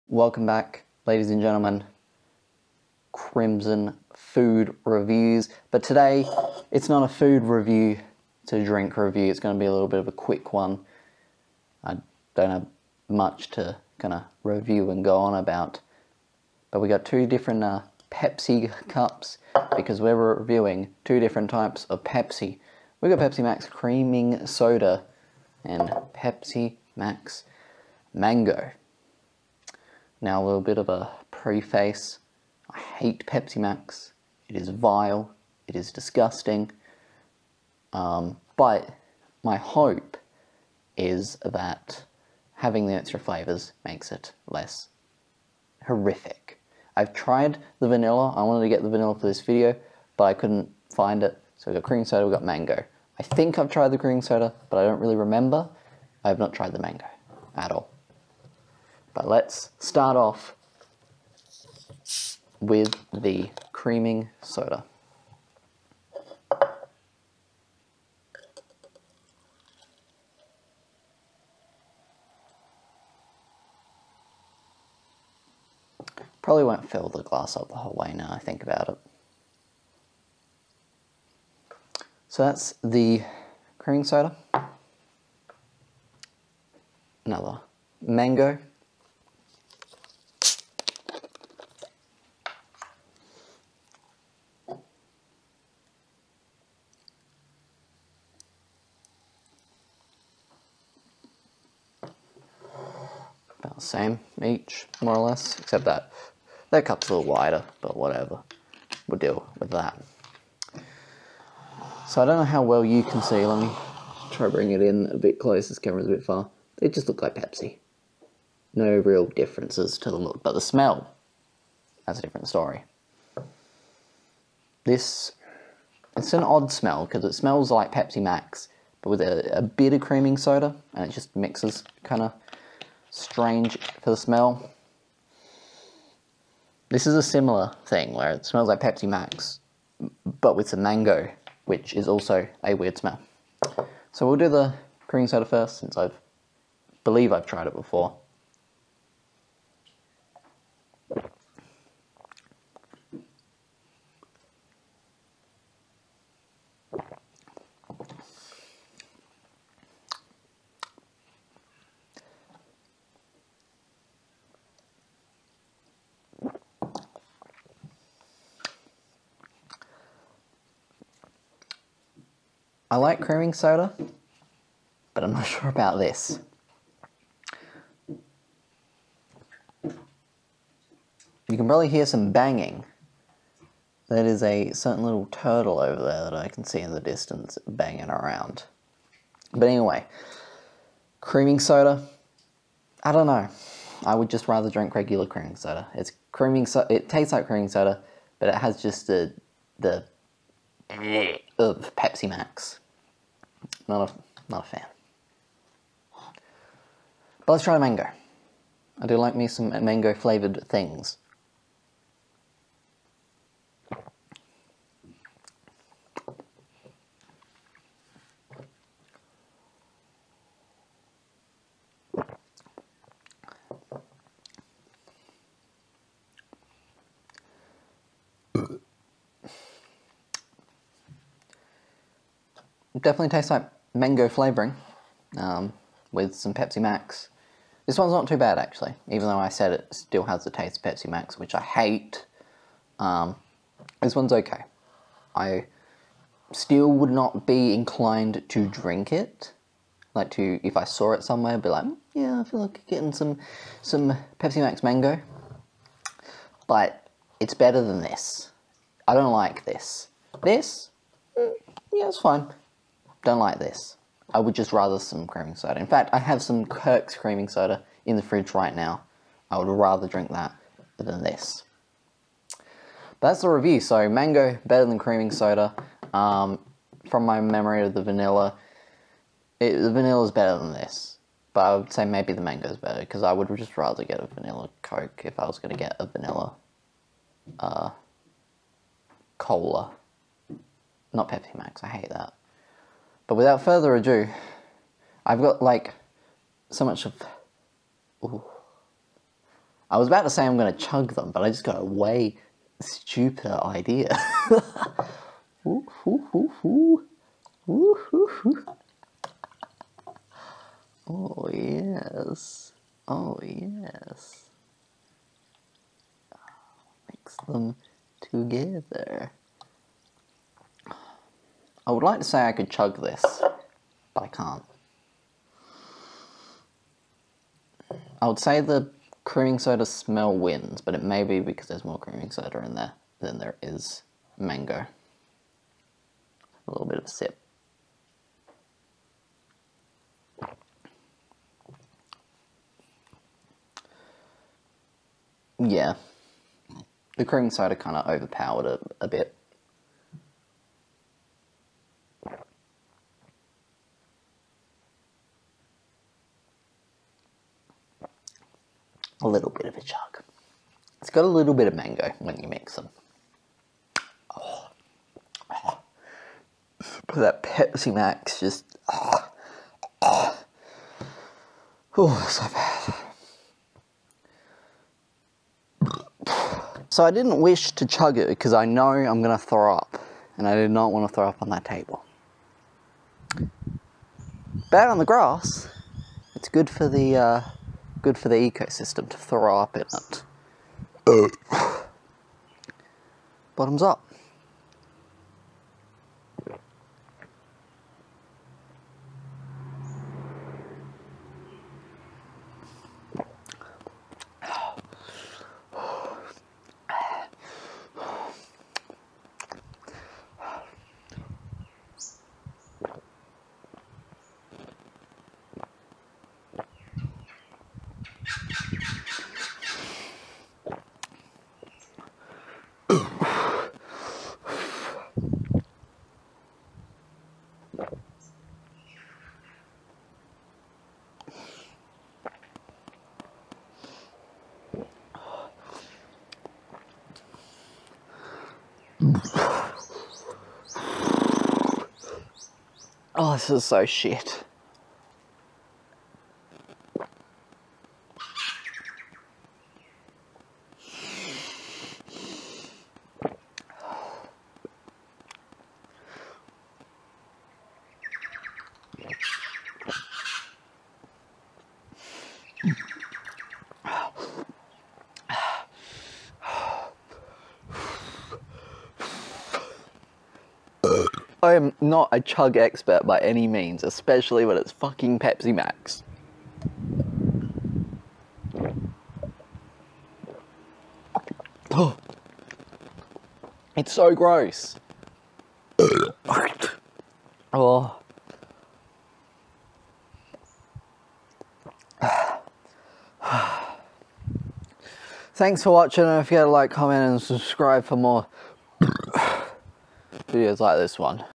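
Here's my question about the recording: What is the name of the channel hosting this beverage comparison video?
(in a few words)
Crimson Food Reviews.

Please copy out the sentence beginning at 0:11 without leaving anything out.
I don't have much to kind of review and go on about.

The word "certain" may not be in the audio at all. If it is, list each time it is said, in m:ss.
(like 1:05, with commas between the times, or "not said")
3:04.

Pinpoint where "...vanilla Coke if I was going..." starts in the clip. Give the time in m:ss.
4:44.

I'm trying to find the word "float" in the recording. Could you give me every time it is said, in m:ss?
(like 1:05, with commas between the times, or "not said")
not said.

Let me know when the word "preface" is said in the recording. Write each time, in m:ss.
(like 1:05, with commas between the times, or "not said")
0:31.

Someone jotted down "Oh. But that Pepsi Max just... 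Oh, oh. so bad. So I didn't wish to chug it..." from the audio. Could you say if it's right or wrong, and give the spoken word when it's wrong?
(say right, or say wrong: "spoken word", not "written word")
right.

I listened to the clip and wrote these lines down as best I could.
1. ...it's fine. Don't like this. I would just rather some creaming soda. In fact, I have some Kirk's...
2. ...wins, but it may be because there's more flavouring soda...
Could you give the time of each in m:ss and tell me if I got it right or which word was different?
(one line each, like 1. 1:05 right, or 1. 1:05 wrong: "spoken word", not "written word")
1. 4:22 right
2. 5:30 wrong: "creaming", not "flavouring".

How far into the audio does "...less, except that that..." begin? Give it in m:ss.
1:45.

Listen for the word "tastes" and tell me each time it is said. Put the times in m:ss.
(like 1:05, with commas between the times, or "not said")
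3:17, 3:53, 4:00.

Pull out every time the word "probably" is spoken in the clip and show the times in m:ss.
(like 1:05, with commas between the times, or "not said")
1:16, 3:01.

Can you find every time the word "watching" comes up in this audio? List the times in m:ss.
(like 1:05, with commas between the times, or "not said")
8:15.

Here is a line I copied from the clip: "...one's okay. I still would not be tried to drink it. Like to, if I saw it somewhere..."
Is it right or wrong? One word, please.
wrong.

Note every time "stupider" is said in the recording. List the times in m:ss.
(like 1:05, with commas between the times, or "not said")
5:02.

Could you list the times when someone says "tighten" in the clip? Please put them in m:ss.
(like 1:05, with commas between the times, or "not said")
not said.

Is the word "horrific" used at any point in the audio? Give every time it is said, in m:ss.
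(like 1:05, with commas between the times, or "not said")
0:45.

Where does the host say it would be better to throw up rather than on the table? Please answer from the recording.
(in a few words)
On the grass.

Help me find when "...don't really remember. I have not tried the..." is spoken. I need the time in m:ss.
0:54.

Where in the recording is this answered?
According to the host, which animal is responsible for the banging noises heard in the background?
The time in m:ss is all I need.
3:05.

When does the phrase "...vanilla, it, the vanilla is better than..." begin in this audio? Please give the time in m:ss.
4:38.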